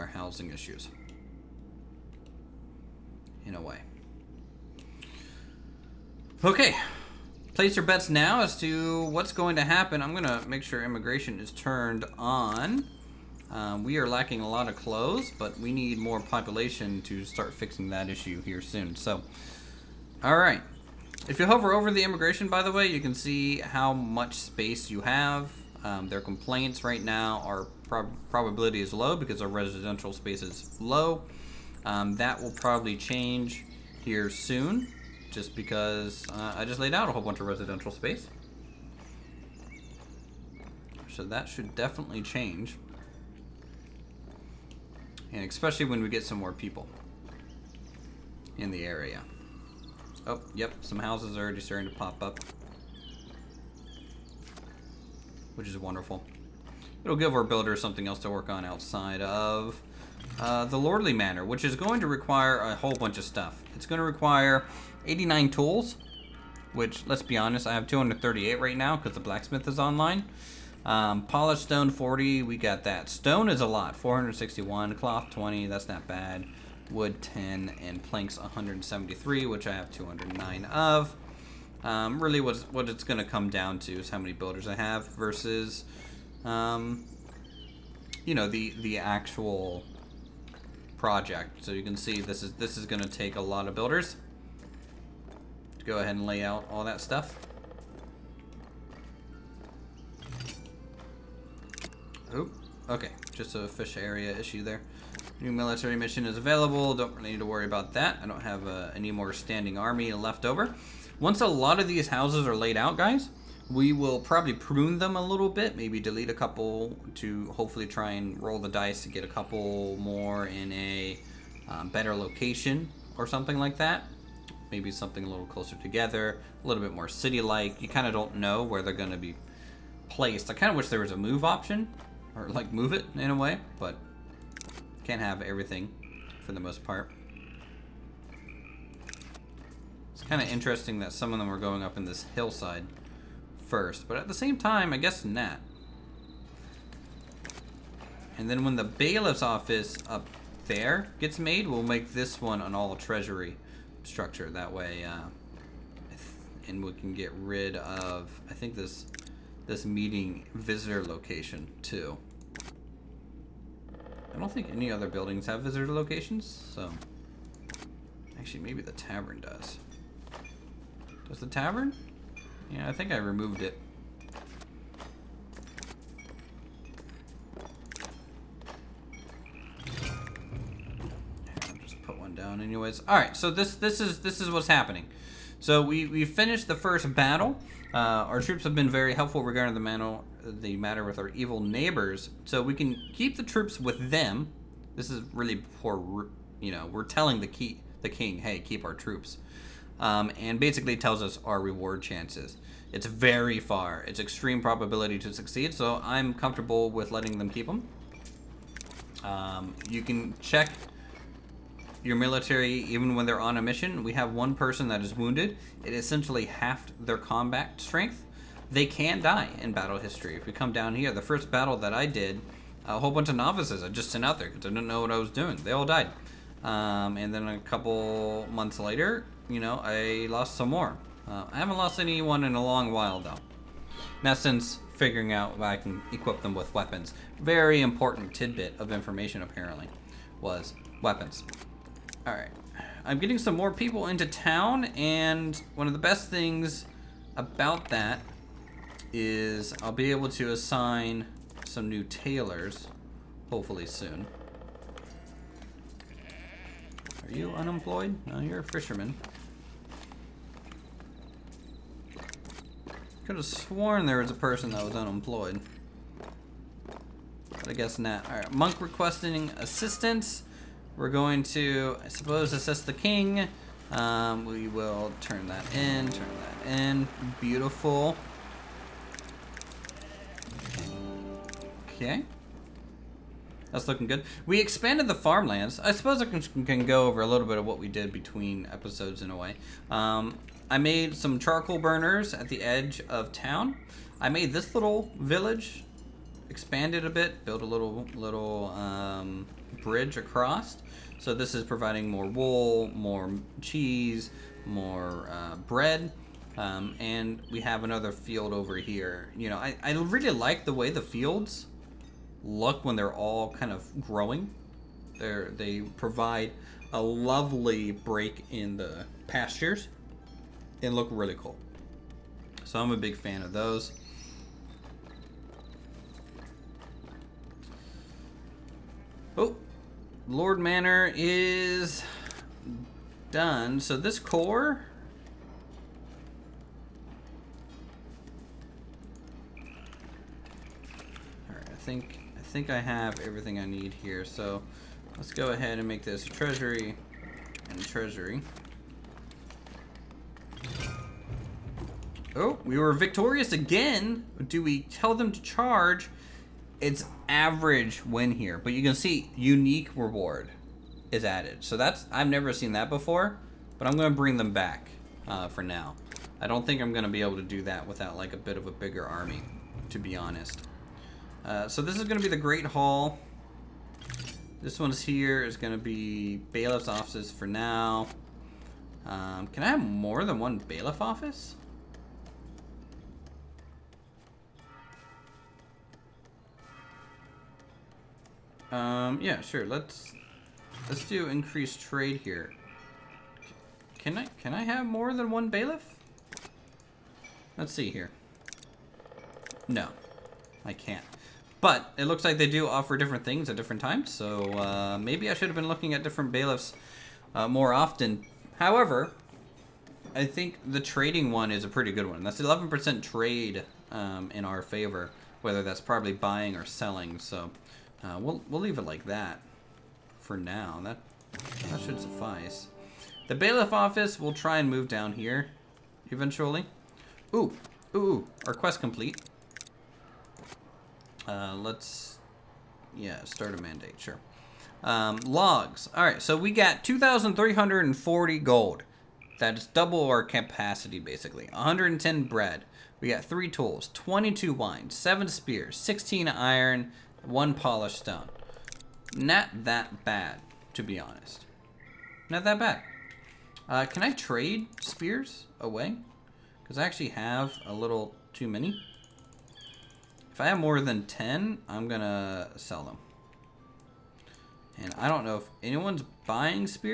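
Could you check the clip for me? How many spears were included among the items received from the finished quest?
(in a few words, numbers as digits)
7.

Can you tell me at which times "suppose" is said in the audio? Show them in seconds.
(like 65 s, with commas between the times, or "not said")
272 s, 285 s.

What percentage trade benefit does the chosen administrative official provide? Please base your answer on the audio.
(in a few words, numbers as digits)
11%.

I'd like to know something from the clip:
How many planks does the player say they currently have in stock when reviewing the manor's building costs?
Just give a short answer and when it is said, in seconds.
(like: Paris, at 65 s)
209, at 79 s.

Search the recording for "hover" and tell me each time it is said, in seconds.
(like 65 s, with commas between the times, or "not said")
21 s.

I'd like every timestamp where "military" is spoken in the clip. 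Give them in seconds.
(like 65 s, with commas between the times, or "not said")
105 s, 212 s.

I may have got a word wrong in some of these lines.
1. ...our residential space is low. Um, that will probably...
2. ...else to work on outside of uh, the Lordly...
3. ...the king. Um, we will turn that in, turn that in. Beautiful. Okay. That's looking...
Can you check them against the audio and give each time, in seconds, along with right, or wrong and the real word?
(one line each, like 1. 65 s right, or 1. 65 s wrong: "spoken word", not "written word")
1. 29 s right
2. 58 s right
3. 272 s right.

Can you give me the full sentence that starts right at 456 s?
Because I actually have a little too many.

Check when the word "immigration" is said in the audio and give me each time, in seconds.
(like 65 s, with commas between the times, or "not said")
10 s, 22 s.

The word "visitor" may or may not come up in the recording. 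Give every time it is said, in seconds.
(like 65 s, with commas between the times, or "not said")
160 s, 165 s.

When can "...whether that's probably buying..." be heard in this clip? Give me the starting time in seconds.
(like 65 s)
415 s.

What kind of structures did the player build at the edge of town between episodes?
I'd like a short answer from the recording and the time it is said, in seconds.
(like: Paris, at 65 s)
charcoal burners, at 291 s.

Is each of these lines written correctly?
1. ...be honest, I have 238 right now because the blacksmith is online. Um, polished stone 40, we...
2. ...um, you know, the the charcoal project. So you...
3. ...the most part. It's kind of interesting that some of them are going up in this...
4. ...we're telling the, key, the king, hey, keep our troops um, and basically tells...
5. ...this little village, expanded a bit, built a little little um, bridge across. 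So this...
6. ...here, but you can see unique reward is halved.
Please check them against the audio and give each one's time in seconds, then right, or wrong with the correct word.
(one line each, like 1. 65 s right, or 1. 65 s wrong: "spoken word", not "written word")
1. 67 s right
2. 86 s wrong: "actual", not "charcoal"
3. 136 s right
4. 196 s right
5. 294 s right
6. 358 s wrong: "added", not "halved".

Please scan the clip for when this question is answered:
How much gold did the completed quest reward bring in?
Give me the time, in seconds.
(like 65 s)
436 s.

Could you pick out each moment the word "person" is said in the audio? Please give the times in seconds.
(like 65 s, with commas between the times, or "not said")
214 s, 264 s.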